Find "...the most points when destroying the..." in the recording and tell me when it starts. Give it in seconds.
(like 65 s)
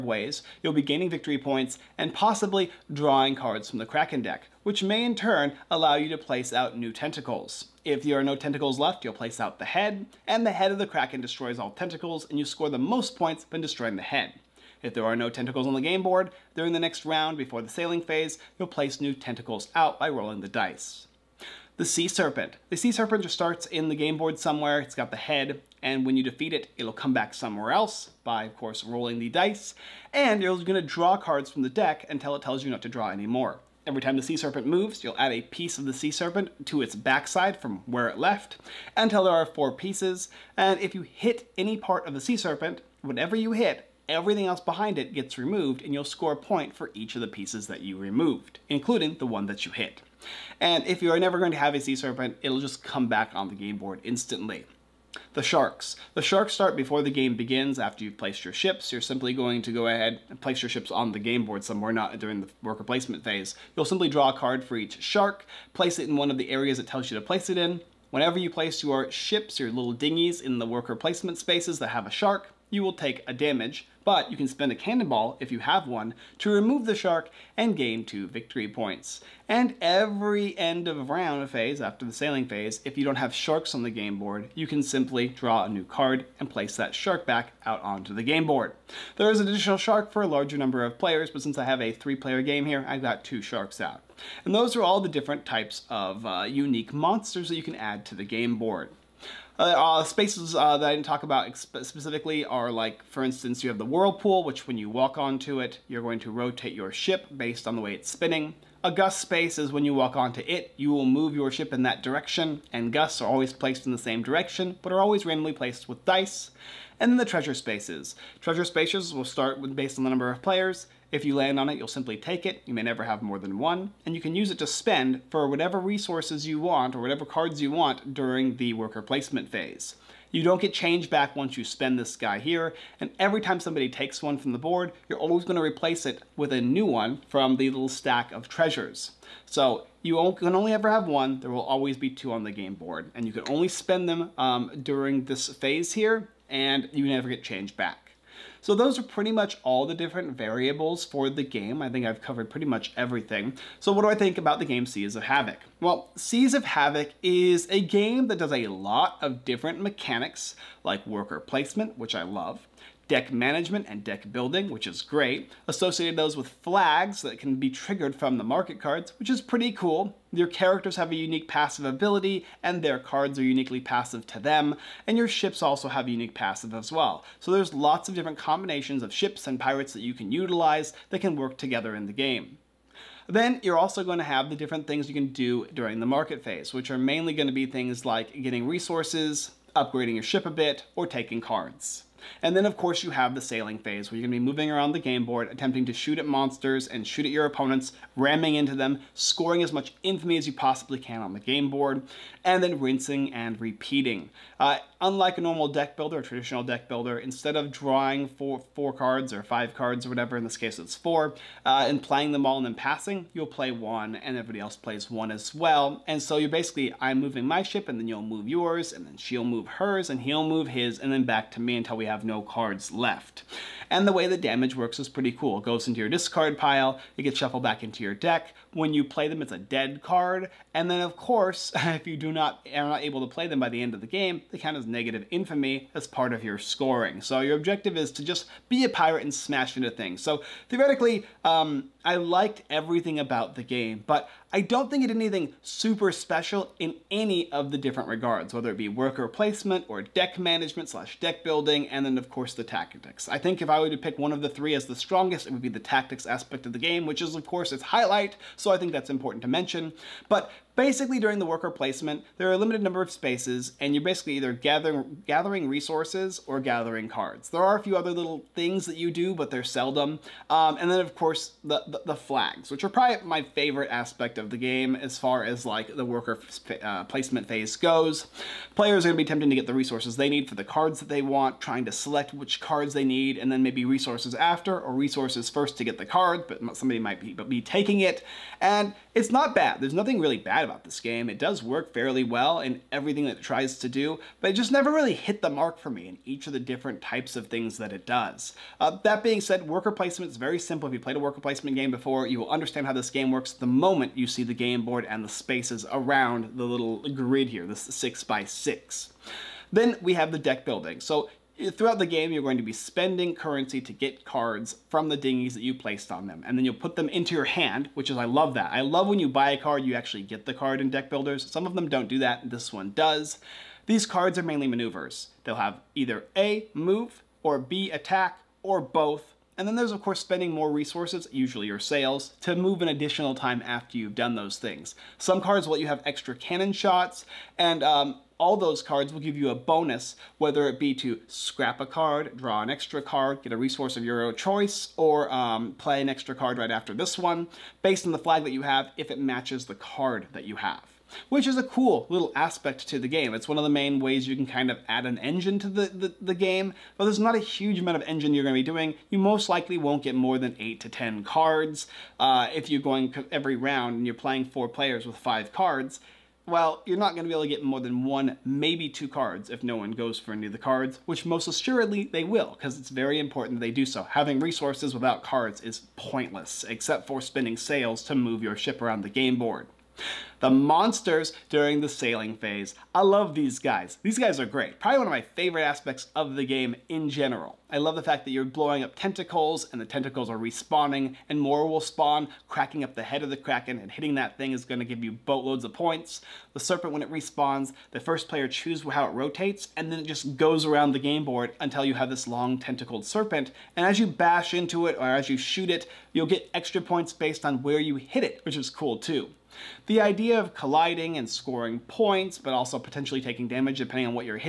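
12 s.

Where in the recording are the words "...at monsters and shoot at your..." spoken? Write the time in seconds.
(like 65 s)
196 s.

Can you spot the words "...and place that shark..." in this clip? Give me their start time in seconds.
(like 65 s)
86 s.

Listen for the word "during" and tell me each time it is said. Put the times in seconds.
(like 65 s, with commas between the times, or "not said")
16 s, 62 s, 128 s, 144 s, 185 s, 261 s, 381 s.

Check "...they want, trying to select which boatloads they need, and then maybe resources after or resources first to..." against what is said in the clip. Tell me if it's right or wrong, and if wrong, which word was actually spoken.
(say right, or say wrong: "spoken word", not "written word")
wrong: "cards", not "boatloads".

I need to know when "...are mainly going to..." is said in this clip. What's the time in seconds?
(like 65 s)
186 s.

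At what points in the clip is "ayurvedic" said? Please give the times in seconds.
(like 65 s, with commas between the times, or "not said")
not said.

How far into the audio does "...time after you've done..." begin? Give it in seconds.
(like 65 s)
333 s.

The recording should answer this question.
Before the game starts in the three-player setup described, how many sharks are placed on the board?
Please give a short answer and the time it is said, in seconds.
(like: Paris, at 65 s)
2, at 93 s.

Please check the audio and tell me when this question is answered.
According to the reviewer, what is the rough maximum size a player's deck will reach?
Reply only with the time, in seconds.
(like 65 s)
360 s.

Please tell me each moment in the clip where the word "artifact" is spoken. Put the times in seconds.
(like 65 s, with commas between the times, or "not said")
not said.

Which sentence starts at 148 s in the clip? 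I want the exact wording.
So those are pretty much all the different variables for the game.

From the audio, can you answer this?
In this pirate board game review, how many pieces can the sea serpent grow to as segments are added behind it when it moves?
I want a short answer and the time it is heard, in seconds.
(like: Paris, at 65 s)
4, at 39 s.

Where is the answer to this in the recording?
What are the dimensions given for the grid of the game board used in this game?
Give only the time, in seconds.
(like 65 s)
307 s.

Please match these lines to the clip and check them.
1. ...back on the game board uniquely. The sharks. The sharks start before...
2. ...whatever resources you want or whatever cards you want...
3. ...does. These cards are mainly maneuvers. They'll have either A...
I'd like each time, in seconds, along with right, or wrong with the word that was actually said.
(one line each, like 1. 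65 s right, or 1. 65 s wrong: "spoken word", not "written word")
1. 53 s wrong: "instantly", not "uniquely"
2. 125 s right
3. 322 s right.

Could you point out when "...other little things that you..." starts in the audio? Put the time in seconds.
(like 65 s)
267 s.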